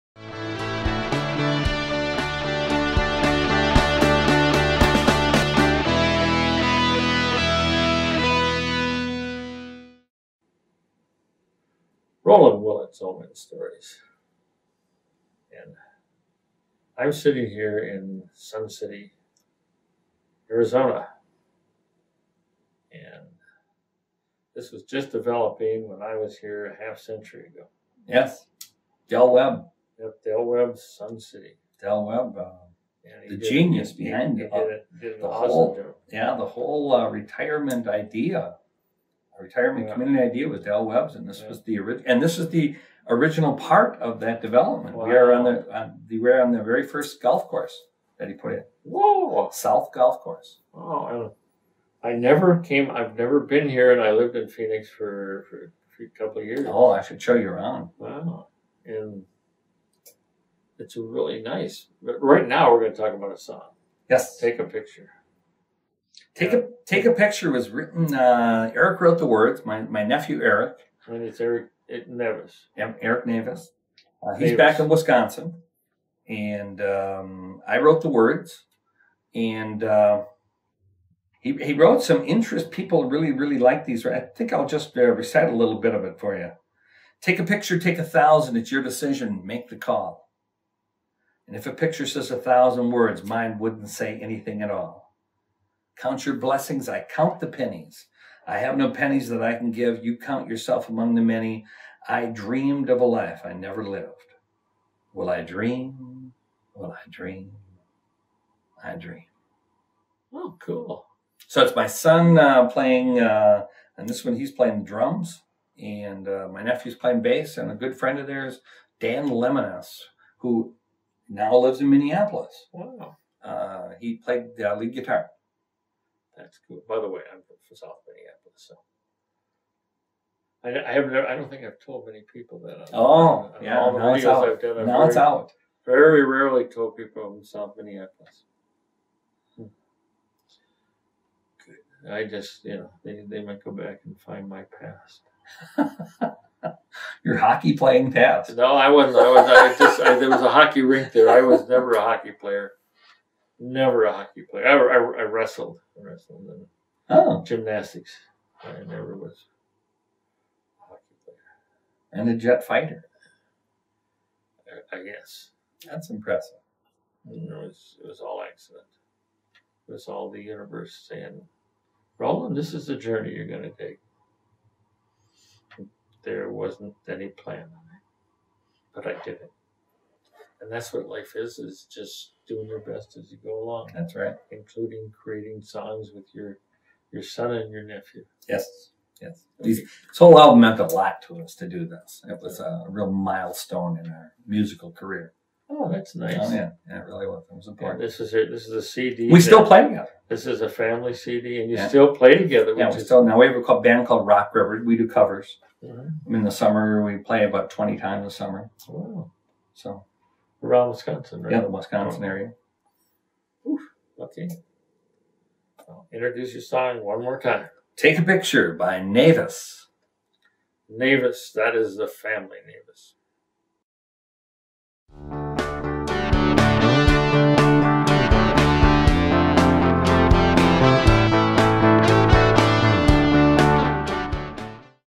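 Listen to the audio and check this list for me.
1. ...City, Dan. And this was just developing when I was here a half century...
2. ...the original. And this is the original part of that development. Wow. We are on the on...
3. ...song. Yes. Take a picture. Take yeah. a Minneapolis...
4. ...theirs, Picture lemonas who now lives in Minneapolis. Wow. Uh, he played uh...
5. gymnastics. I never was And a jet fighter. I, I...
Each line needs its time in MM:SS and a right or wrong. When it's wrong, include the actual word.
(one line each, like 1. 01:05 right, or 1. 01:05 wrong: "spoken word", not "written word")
1. 00:18 wrong: "Arizona", not "Dan"
2. 00:41 right
3. 01:03 wrong: "Take", not "Minneapolis"
4. 01:58 wrong: "Dan", not "Picture"
5. 02:37 right.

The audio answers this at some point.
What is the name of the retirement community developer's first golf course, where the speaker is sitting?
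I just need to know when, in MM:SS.
00:49.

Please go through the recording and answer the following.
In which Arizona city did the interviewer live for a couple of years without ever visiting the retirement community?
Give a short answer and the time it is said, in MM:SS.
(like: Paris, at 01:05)
Phoenix, at 00:54.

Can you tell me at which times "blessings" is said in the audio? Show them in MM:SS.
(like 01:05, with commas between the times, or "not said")
01:36.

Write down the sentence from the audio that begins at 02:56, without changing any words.
There wasn't any plan on it.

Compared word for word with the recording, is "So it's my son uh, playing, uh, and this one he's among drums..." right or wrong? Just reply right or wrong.
wrong.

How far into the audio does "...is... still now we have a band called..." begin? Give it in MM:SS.
03:22.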